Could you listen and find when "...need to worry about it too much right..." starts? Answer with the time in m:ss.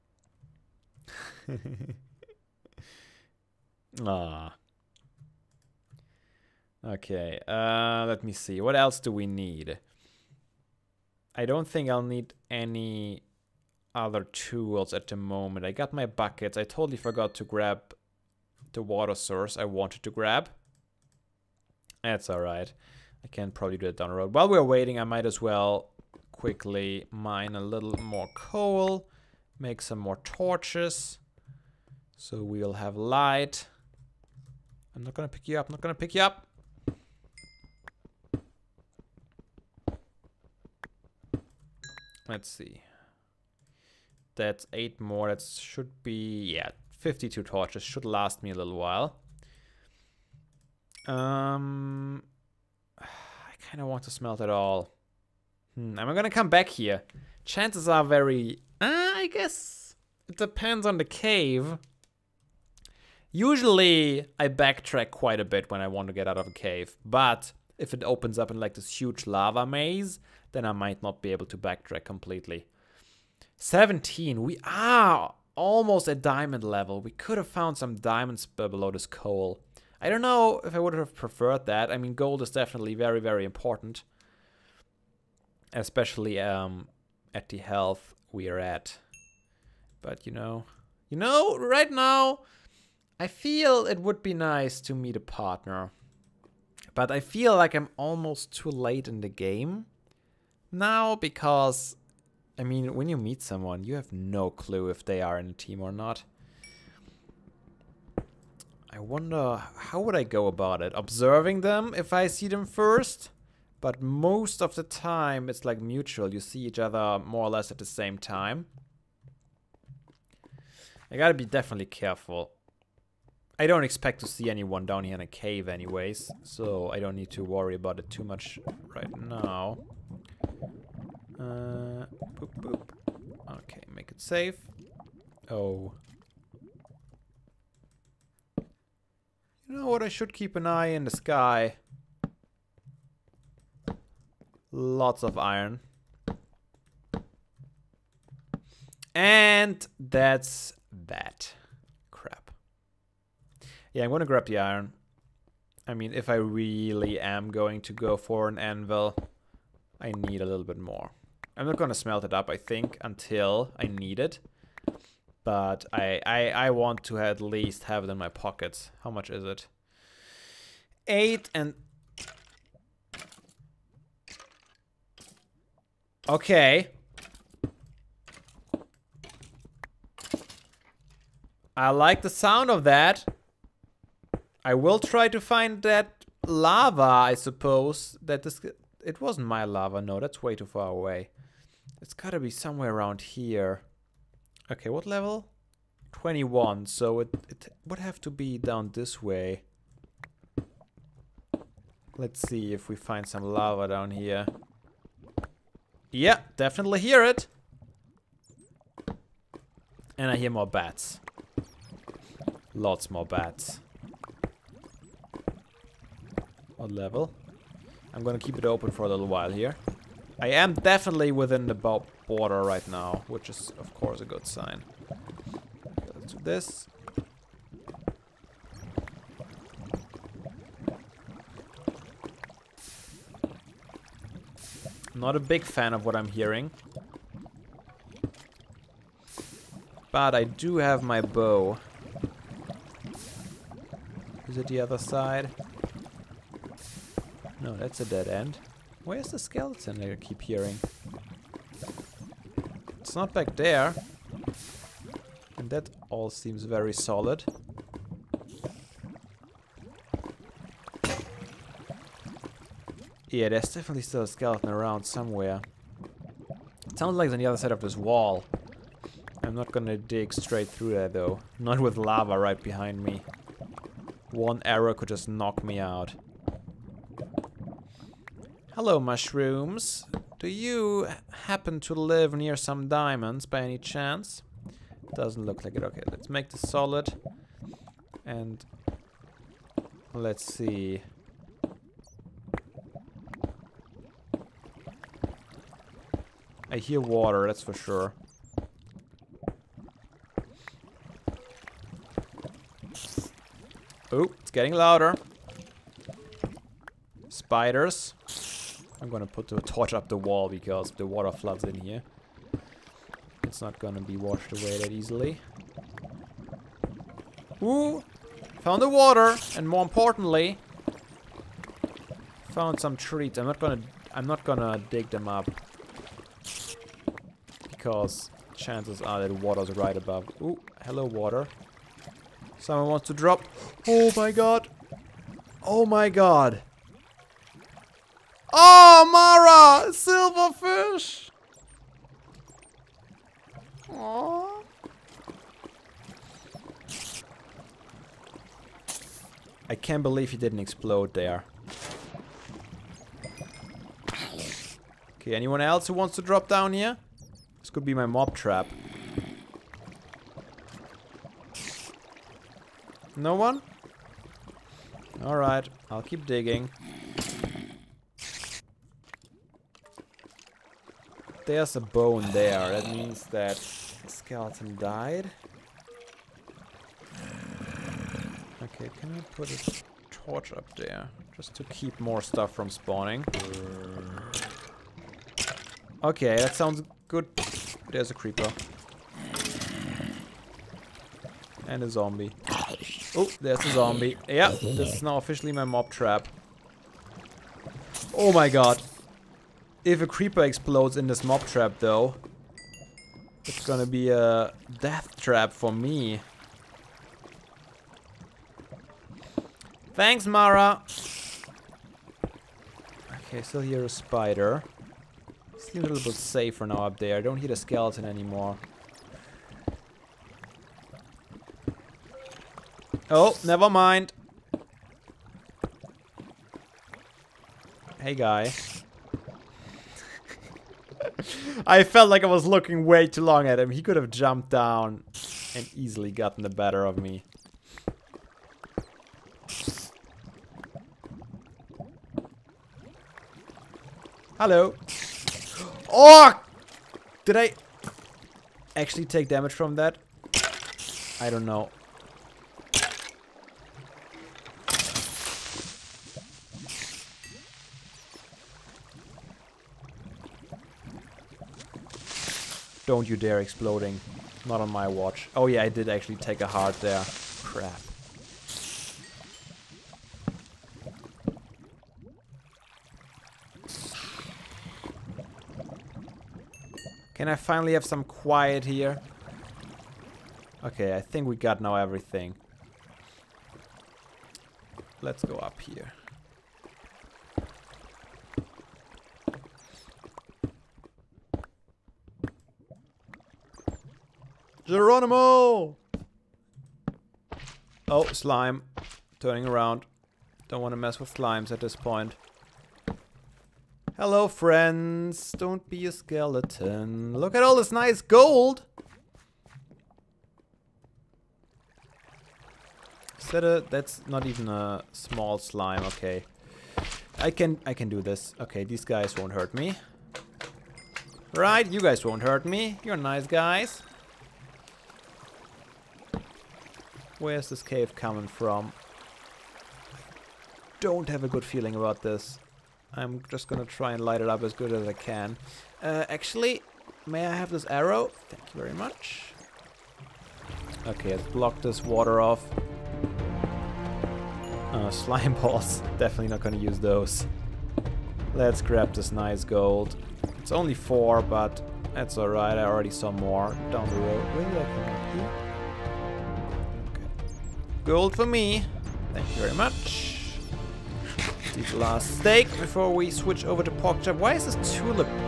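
2:07.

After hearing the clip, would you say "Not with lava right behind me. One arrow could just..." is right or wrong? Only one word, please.
right.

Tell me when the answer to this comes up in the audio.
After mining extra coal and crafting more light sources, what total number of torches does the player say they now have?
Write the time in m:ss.
0:46.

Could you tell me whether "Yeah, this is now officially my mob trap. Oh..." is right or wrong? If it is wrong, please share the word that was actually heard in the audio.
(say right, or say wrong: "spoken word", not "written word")
right.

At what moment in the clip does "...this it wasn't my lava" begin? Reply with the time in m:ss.
3:08.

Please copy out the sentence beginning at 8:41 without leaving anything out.
Right, you guys won't hurt me.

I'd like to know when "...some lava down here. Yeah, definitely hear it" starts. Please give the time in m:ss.
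3:23.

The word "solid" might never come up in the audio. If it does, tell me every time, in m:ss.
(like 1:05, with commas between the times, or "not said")
4:16, 4:46.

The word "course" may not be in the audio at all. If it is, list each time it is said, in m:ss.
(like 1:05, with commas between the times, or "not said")
3:43.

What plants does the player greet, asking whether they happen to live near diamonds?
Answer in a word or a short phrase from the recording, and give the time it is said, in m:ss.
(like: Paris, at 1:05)
Mushrooms, at 4:38.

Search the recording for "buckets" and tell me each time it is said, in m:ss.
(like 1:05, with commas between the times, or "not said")
0:16.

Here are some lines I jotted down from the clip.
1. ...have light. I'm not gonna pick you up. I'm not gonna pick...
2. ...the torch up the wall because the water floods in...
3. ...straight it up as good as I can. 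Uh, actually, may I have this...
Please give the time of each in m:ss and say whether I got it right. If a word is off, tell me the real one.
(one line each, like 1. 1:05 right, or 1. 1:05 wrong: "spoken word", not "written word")
1. 0:32 right
2. 5:09 right
3. 8:54 wrong: "light", not "straight".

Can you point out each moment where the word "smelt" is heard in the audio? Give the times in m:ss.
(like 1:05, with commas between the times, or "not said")
0:54, 2:41.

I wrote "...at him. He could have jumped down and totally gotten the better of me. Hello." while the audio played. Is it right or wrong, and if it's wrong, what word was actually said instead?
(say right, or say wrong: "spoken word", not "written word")
wrong: "easily", not "totally".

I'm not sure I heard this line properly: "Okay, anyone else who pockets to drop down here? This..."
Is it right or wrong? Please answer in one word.
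wrong.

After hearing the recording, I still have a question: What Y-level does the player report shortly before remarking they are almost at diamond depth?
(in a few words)
17.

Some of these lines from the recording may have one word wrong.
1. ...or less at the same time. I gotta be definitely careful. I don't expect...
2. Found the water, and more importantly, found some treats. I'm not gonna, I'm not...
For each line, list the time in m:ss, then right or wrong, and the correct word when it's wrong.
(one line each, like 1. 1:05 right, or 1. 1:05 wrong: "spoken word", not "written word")
1. 1:57 right
2. 5:18 right.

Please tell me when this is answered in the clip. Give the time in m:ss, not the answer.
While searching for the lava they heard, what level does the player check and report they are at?
3:16.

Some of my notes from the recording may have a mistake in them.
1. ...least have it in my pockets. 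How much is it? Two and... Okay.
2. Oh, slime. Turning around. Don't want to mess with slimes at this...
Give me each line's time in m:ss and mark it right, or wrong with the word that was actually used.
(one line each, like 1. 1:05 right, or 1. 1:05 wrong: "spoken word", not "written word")
1. 2:47 wrong: "Eight", not "Two"
2. 8:17 right.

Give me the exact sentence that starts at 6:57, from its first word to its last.
I don't hear a skeleton anymore.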